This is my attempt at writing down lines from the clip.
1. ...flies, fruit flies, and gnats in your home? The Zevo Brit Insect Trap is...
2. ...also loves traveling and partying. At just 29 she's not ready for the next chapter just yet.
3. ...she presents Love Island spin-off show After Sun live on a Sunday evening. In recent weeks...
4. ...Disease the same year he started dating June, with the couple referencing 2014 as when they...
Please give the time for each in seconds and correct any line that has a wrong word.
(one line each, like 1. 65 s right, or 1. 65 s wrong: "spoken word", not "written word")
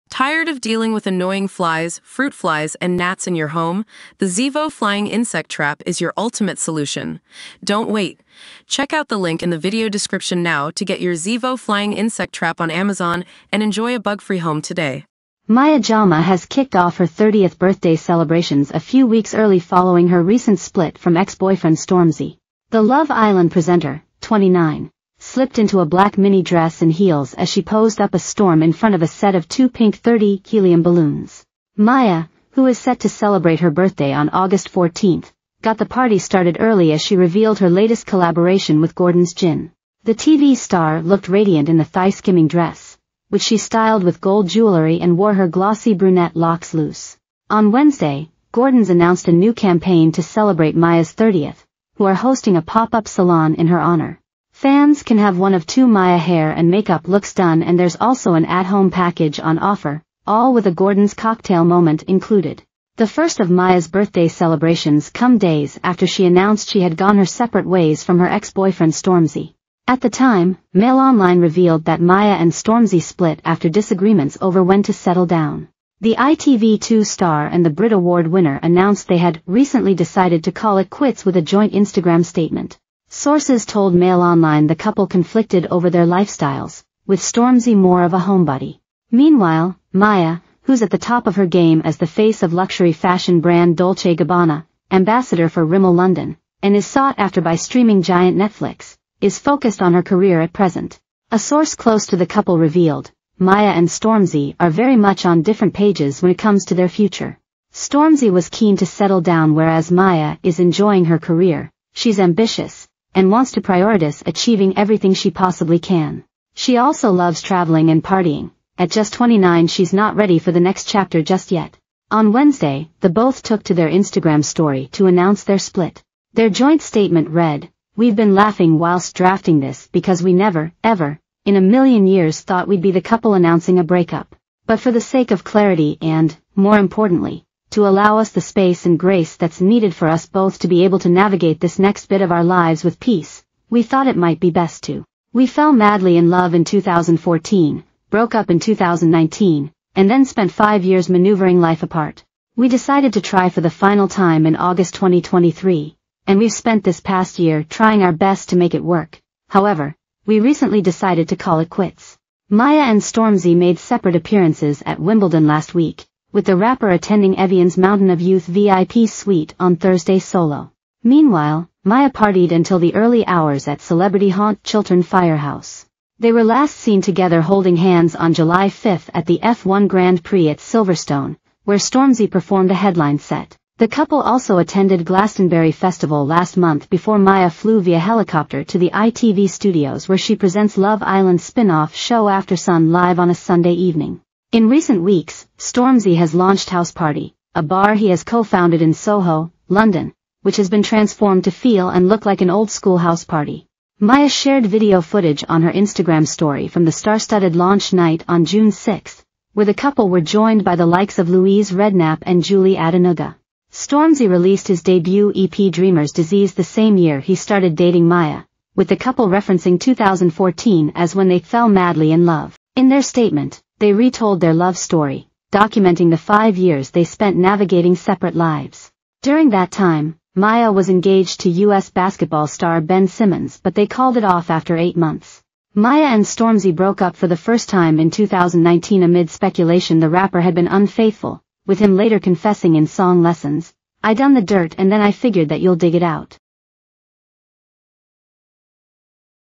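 1. 1 s wrong: "Flying", not "Brit"
2. 116 s right
3. 190 s right
4. 216 s wrong: "Maya", not "June".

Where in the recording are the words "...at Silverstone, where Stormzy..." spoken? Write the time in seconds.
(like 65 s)
180 s.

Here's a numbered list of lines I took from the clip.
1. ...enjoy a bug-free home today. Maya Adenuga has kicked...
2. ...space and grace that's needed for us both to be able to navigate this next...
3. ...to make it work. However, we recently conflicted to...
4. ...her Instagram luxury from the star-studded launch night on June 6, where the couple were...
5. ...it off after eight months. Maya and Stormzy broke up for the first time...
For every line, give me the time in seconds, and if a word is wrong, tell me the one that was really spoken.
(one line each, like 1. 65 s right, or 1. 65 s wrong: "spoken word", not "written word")
1. 13 s wrong: "Jama", not "Adenuga"
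2. 138 s right
3. 158 s wrong: "decided", not "conflicted"
4. 205 s wrong: "story", not "luxury"
5. 234 s right.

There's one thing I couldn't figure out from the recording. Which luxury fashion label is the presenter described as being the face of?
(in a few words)
Dolce Gabbana.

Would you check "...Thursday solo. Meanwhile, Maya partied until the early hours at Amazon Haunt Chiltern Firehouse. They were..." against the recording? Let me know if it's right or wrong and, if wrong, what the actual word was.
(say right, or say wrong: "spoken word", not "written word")
wrong: "Celebrity", not "Amazon".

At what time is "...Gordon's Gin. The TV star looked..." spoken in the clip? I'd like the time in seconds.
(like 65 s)
38 s.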